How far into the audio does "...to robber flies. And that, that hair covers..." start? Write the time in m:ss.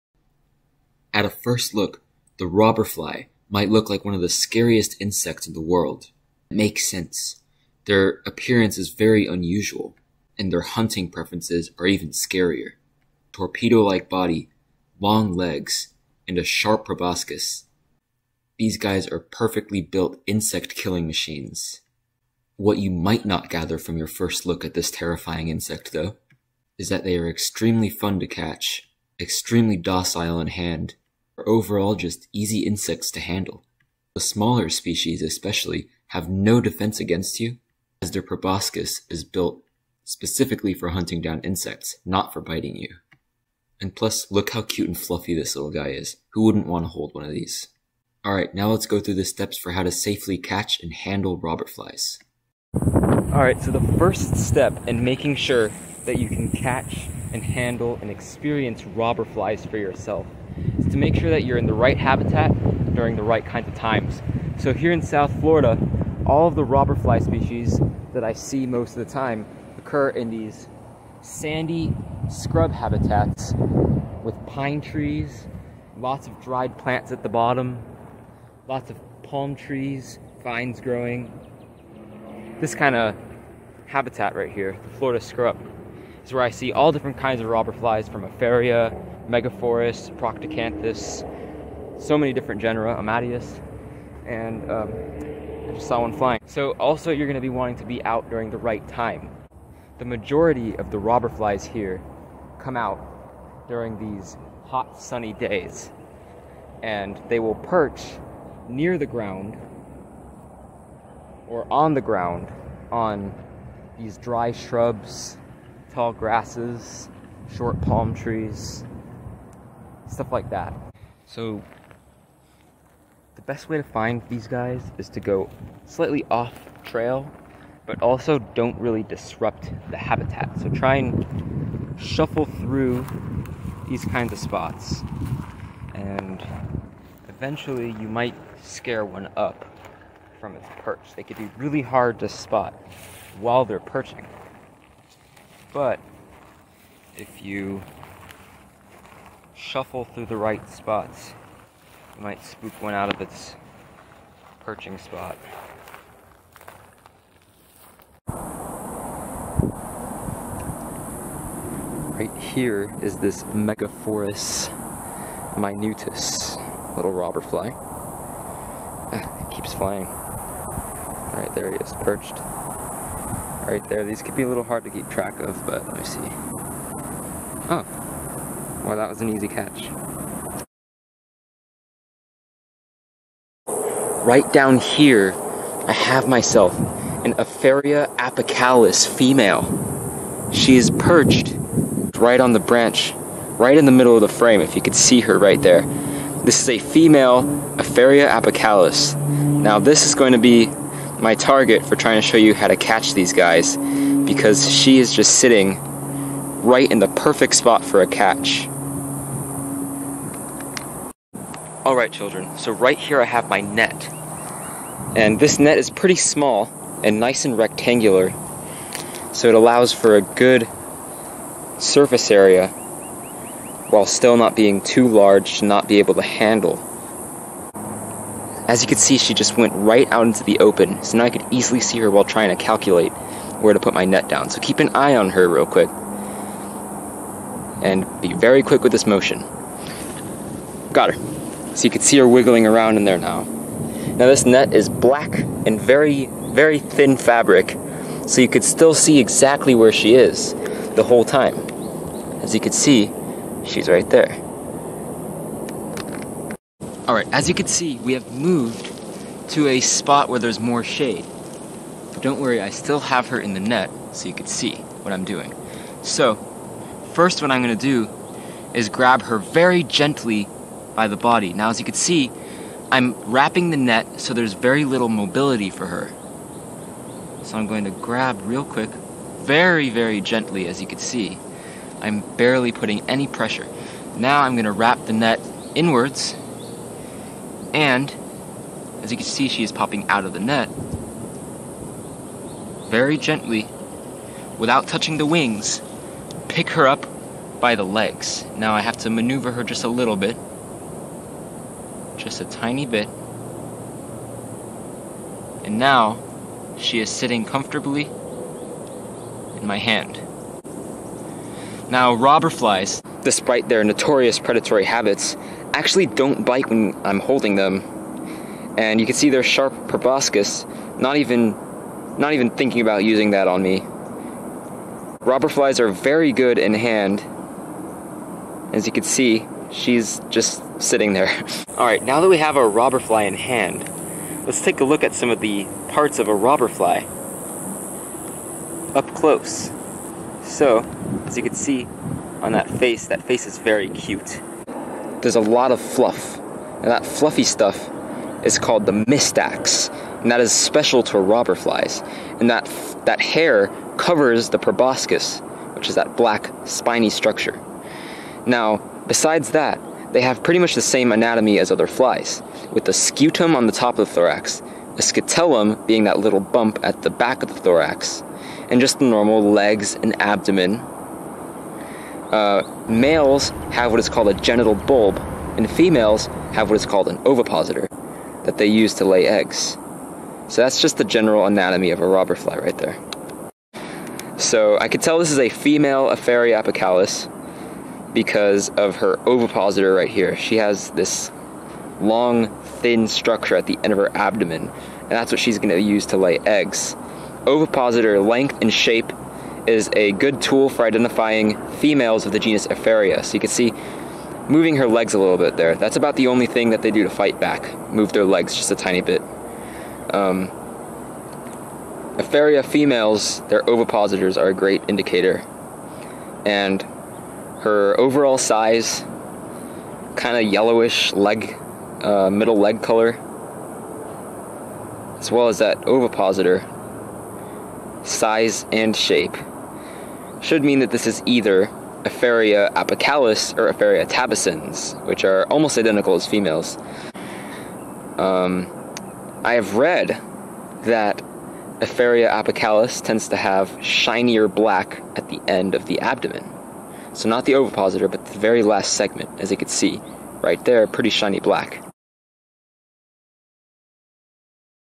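5:51.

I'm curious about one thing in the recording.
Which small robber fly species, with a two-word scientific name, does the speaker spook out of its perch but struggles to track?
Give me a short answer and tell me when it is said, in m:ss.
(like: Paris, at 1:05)
Megaphorus minutus, at 2:43.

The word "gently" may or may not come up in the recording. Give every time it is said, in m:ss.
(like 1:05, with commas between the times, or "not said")
4:29, 4:40, 4:53.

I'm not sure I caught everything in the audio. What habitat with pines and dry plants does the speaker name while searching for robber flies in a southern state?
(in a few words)
Florida scrub.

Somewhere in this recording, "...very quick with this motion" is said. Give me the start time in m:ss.
3:58.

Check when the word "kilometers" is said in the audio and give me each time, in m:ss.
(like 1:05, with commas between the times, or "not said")
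not said.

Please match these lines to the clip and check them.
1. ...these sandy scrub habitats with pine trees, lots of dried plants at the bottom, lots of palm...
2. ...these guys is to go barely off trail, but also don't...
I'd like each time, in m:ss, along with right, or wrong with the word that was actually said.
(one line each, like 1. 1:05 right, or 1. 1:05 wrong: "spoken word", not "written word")
1. 1:10 right
2. 2:04 wrong: "slightly", not "barely".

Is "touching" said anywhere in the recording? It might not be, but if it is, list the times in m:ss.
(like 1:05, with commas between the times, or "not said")
4:54.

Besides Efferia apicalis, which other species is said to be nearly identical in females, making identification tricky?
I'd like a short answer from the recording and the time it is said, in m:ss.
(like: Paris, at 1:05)
Efferia tabacins, at 7:13.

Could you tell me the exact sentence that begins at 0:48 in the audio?
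Alright, now let's go through the steps for how to safely catch and handle robber flies.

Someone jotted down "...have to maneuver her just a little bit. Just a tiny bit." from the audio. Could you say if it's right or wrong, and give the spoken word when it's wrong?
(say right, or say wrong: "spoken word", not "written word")
right.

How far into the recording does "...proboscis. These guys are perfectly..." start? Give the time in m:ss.
0:16.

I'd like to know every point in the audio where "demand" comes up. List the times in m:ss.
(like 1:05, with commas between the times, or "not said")
not said.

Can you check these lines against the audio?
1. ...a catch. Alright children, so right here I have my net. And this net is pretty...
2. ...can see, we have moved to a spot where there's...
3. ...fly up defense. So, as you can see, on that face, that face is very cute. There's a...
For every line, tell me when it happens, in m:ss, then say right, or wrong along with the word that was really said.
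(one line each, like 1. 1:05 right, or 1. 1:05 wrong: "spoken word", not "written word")
1. 3:28 right
2. 4:17 right
3. 5:36 wrong: "close", not "defense".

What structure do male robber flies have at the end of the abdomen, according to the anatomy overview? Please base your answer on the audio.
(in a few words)
Genital bulb.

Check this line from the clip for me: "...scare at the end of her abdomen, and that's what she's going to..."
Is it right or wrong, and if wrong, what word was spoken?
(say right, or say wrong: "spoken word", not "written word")
wrong: "structure", not "scare".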